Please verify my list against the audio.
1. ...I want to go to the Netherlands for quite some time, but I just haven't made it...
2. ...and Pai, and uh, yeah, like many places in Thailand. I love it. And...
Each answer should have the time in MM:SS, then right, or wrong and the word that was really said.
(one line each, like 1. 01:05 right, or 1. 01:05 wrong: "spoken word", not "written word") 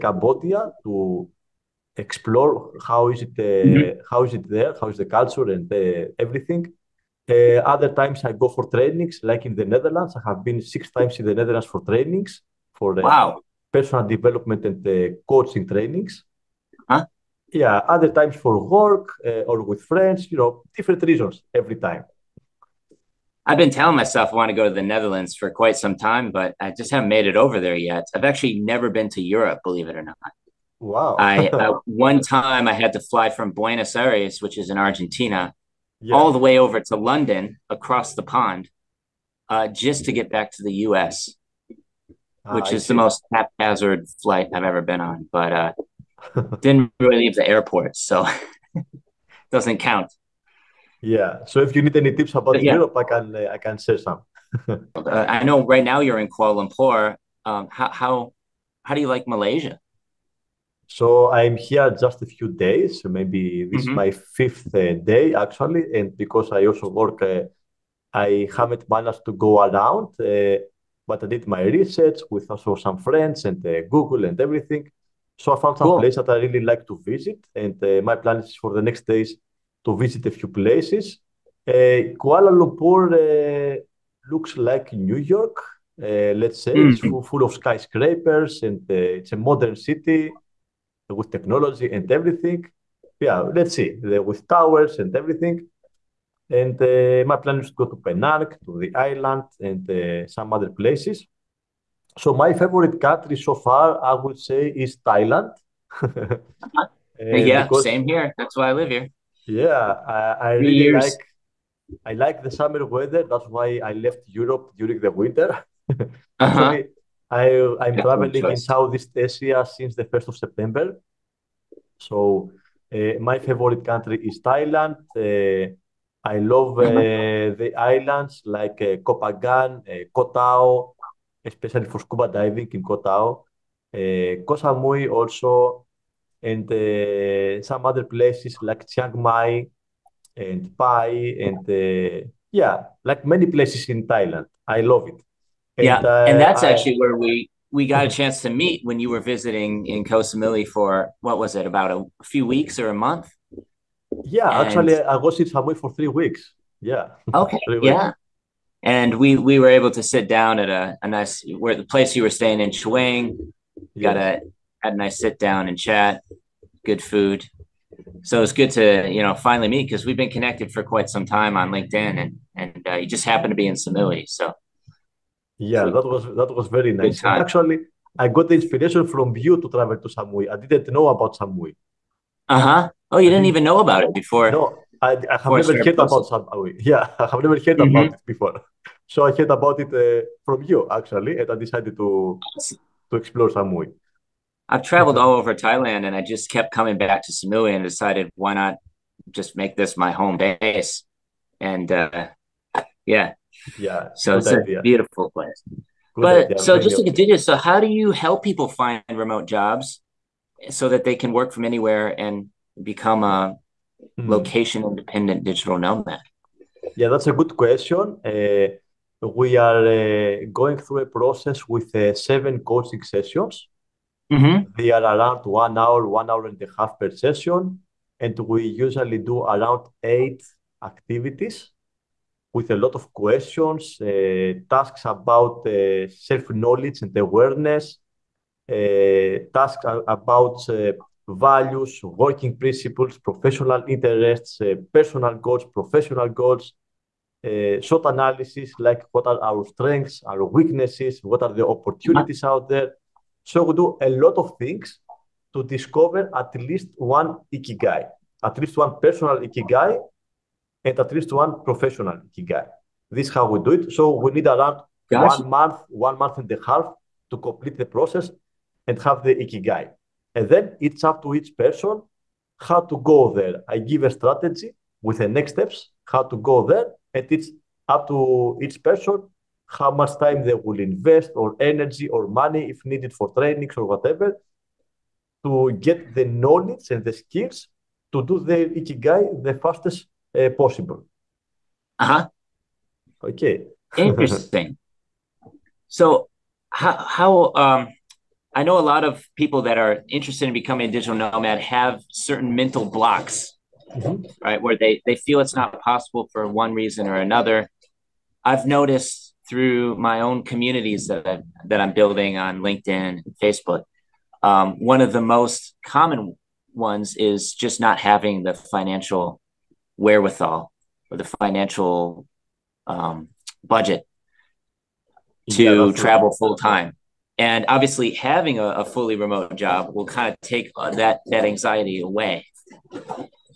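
1. 00:24 right
2. 02:20 right.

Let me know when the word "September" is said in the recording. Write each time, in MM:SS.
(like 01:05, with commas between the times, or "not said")
02:00.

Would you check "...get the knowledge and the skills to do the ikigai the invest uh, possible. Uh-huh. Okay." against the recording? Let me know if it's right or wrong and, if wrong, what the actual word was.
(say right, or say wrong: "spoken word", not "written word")
wrong: "fastest", not "invest".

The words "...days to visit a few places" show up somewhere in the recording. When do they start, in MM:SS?
01:19.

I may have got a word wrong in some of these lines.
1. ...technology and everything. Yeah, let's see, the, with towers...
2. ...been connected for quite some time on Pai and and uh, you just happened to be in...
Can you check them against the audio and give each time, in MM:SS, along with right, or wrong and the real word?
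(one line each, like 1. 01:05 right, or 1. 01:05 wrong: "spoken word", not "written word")
1. 01:31 right
2. 02:50 wrong: "LinkedIn", not "Pai".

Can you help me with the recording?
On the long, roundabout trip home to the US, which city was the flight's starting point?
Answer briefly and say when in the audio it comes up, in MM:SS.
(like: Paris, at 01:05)
Buenos Aires, at 00:33.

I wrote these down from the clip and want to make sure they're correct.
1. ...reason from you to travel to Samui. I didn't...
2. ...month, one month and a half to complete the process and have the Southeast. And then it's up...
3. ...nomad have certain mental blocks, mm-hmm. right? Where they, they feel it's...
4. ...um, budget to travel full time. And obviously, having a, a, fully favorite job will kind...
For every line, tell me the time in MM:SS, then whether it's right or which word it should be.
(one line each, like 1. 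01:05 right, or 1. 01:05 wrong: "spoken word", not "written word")
1. 02:58 wrong: "inspiration", not "reason"
2. 04:25 wrong: "Ikigai", not "Southeast"
3. 05:01 right
4. 05:22 wrong: "remote", not "favorite".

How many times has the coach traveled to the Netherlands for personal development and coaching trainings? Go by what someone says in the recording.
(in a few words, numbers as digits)
6.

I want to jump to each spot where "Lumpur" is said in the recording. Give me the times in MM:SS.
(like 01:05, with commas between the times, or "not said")
00:56, 01:22.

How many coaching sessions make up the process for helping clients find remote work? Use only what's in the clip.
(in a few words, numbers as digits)
7.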